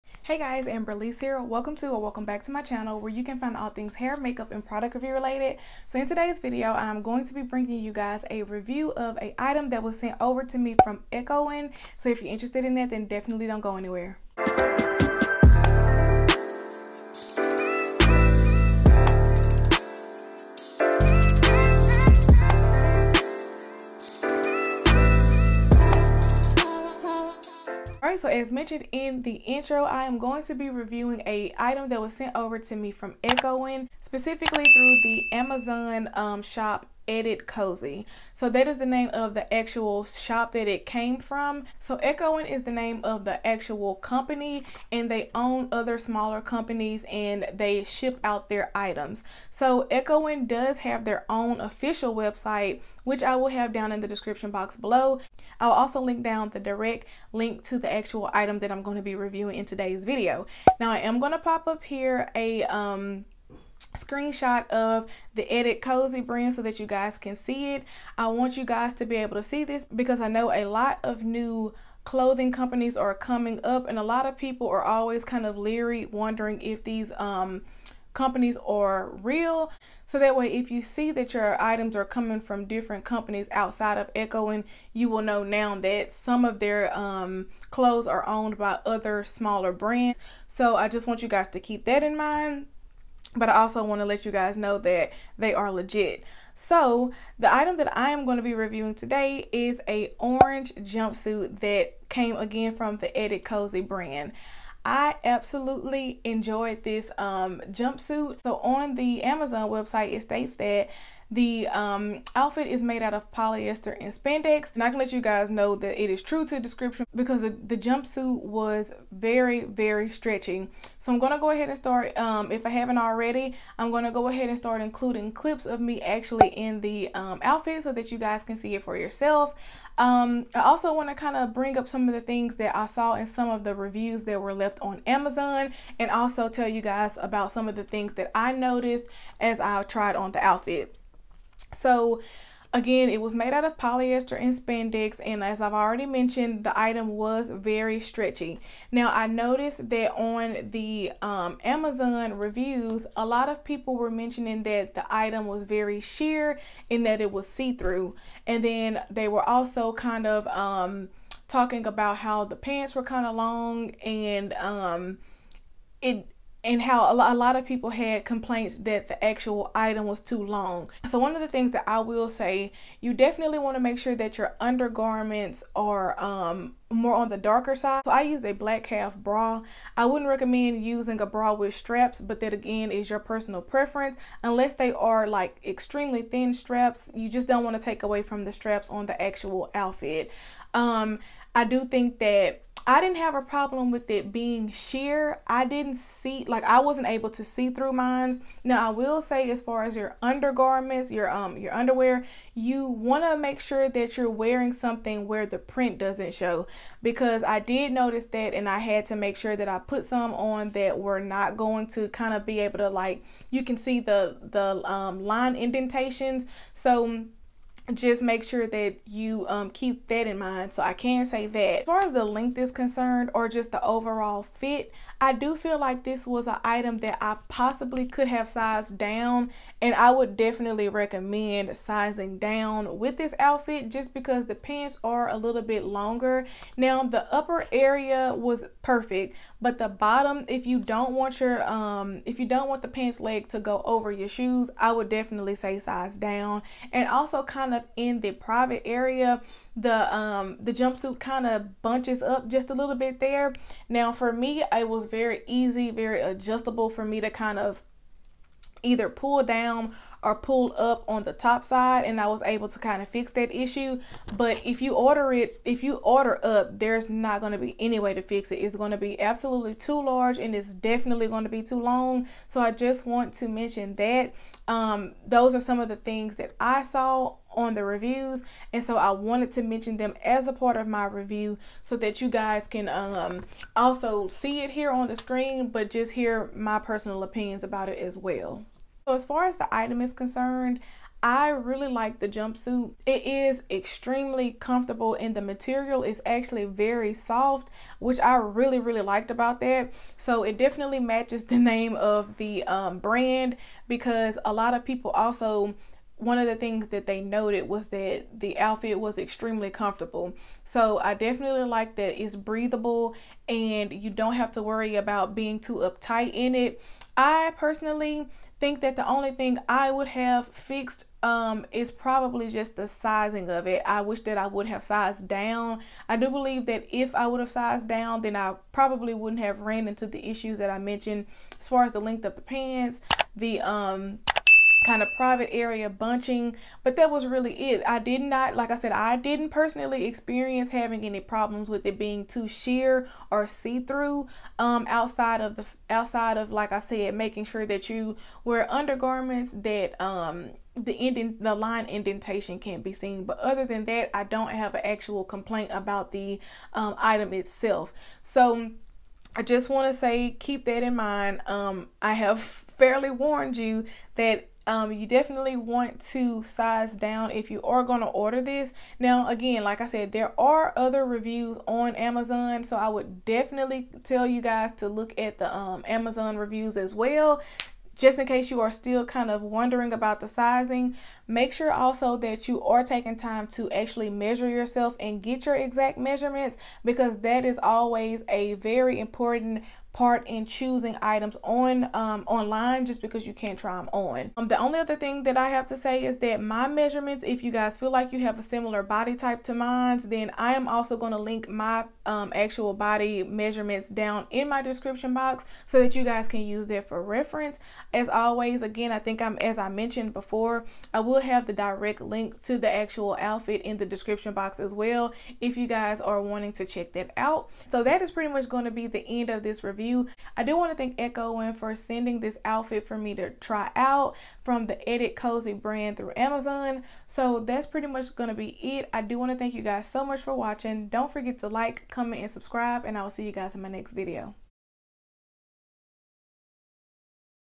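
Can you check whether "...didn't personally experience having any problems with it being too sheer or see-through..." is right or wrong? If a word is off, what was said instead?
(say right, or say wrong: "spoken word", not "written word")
right.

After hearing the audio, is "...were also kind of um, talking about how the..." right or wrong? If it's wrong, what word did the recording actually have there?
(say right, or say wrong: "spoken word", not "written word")
right.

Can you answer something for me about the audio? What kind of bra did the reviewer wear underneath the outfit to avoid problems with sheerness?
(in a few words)
Black half bra.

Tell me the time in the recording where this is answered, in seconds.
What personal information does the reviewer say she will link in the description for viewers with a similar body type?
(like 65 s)
402 s.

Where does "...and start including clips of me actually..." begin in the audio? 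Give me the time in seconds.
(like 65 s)
124 s.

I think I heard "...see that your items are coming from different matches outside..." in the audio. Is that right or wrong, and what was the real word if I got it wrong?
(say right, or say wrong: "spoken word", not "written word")
wrong: "companies", not "matches".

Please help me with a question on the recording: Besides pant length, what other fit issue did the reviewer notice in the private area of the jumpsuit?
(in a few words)
Bunching.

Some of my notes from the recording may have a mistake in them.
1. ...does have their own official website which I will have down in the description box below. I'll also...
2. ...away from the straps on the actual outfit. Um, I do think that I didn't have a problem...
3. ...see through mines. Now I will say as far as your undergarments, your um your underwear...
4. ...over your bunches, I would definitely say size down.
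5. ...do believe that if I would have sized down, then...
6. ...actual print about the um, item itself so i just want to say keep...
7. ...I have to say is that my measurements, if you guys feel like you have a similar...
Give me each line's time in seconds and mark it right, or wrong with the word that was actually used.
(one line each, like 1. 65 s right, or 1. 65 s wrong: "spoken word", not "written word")
1. 50 s right
2. 188 s right
3. 197 s right
4. 243 s wrong: "shoes", not "bunches"
5. 326 s right
6. 354 s wrong: "complaint", not "print"
7. 395 s right.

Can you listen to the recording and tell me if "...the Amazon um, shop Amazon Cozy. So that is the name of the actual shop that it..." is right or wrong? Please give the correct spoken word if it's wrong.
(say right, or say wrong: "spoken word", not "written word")
wrong: "Edit", not "Amazon".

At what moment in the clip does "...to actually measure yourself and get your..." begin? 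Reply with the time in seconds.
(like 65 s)
383 s.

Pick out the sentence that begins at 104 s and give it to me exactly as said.
I absolutely enjoyed this um, jumpsuit.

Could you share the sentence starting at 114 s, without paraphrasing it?
And I can let you guys know that it is true to description because the, the jumpsuit was very, very stretchy.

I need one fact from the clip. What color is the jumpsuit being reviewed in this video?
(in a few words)
Orange.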